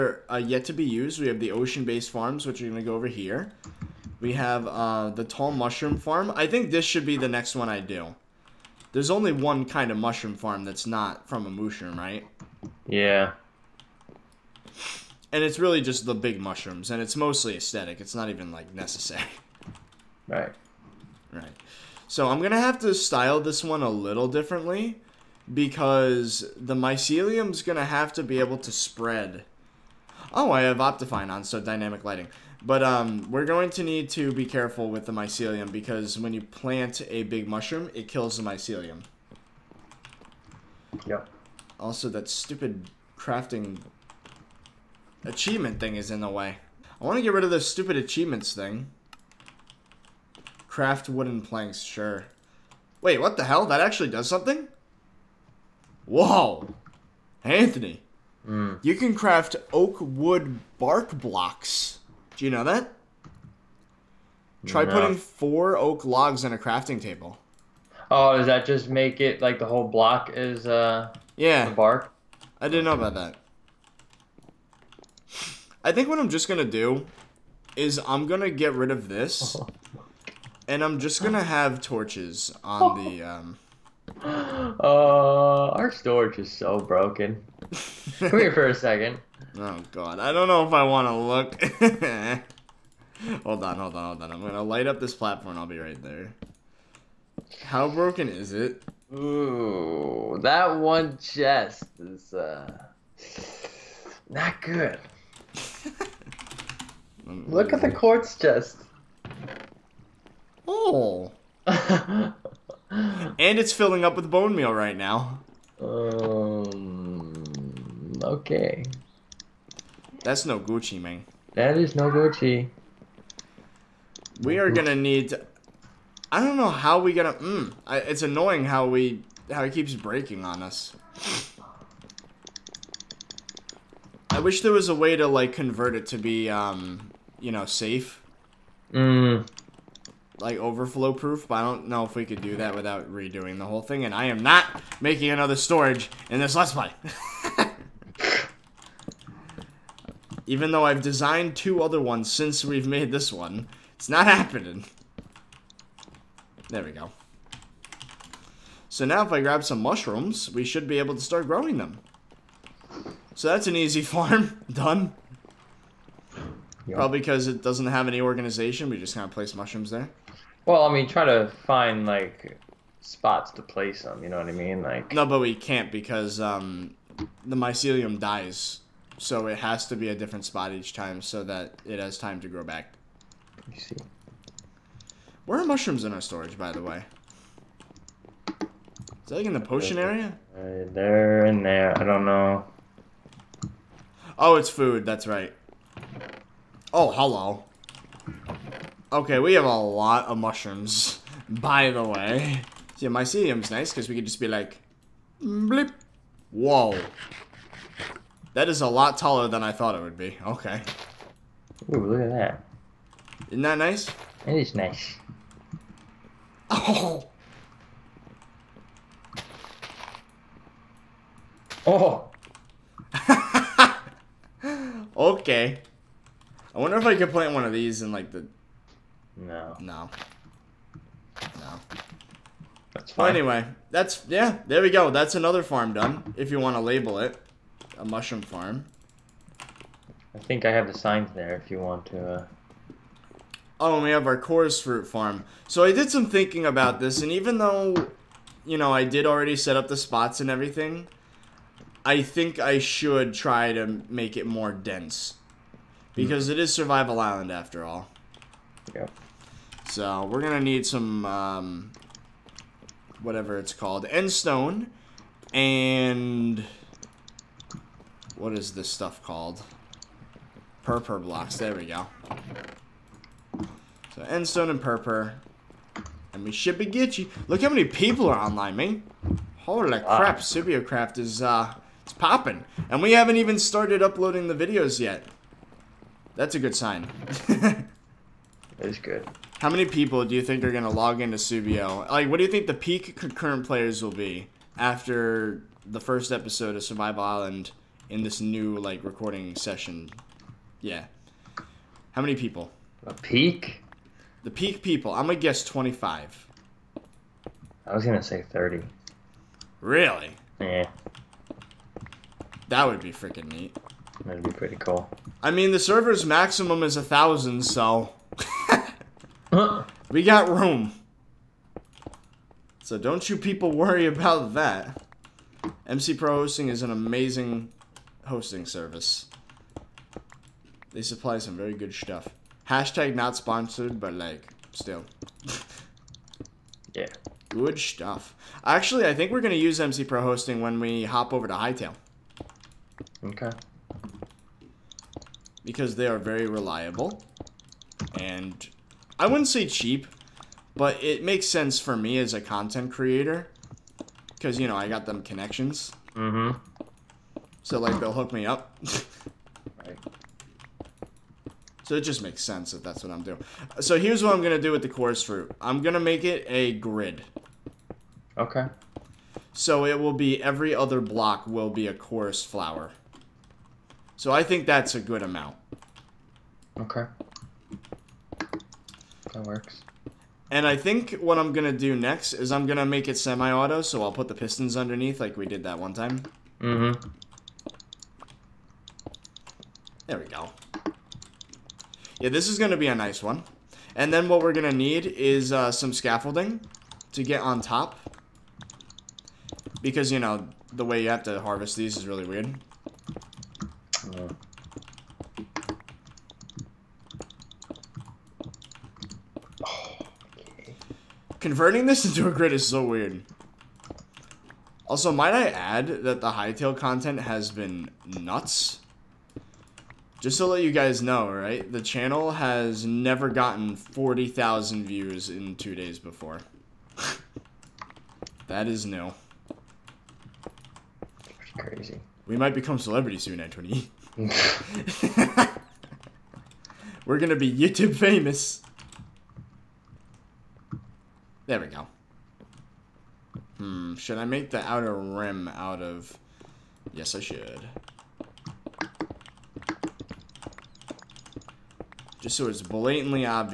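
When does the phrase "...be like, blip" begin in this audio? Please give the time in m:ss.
3:24.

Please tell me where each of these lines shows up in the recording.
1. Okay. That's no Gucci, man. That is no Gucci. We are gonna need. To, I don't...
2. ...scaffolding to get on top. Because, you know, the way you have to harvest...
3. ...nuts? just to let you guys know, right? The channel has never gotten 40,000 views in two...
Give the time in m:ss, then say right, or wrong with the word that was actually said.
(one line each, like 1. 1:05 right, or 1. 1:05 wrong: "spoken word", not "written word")
1. 1:58 right
2. 6:35 right
3. 6:58 right.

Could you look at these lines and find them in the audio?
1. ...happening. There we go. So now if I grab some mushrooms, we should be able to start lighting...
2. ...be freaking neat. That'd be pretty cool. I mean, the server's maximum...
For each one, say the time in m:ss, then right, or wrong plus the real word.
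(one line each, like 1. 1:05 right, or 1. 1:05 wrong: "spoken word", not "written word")
1. 2:34 wrong: "growing", not "lighting"
2. 5:13 right.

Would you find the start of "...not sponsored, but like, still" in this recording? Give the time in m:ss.
5:33.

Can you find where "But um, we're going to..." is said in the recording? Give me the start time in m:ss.
0:32.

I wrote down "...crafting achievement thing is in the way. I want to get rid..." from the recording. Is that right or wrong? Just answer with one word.
right.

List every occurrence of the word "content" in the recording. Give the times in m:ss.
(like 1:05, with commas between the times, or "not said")
5:52, 6:56.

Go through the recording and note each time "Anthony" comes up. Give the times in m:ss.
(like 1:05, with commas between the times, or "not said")
0:57, 7:13.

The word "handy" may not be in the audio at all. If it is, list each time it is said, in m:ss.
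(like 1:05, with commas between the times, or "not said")
not said.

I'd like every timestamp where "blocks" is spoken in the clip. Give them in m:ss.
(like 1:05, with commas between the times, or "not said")
1:01, 1:09, 4:31, 6:10.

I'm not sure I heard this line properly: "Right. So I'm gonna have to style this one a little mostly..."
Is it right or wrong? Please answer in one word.
wrong.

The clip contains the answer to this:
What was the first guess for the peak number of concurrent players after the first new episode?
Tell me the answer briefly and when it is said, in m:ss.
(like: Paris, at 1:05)
25, at 5:05.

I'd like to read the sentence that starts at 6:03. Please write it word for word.
So here's what I'm gonna do with the chorus fruit.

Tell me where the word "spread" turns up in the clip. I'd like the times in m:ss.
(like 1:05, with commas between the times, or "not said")
0:28.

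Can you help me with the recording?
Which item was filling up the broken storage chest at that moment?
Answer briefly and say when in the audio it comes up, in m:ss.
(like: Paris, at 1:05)
Bone meal, at 1:54.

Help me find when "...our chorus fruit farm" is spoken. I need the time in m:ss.
4:04.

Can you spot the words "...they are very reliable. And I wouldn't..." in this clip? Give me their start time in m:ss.
5:45.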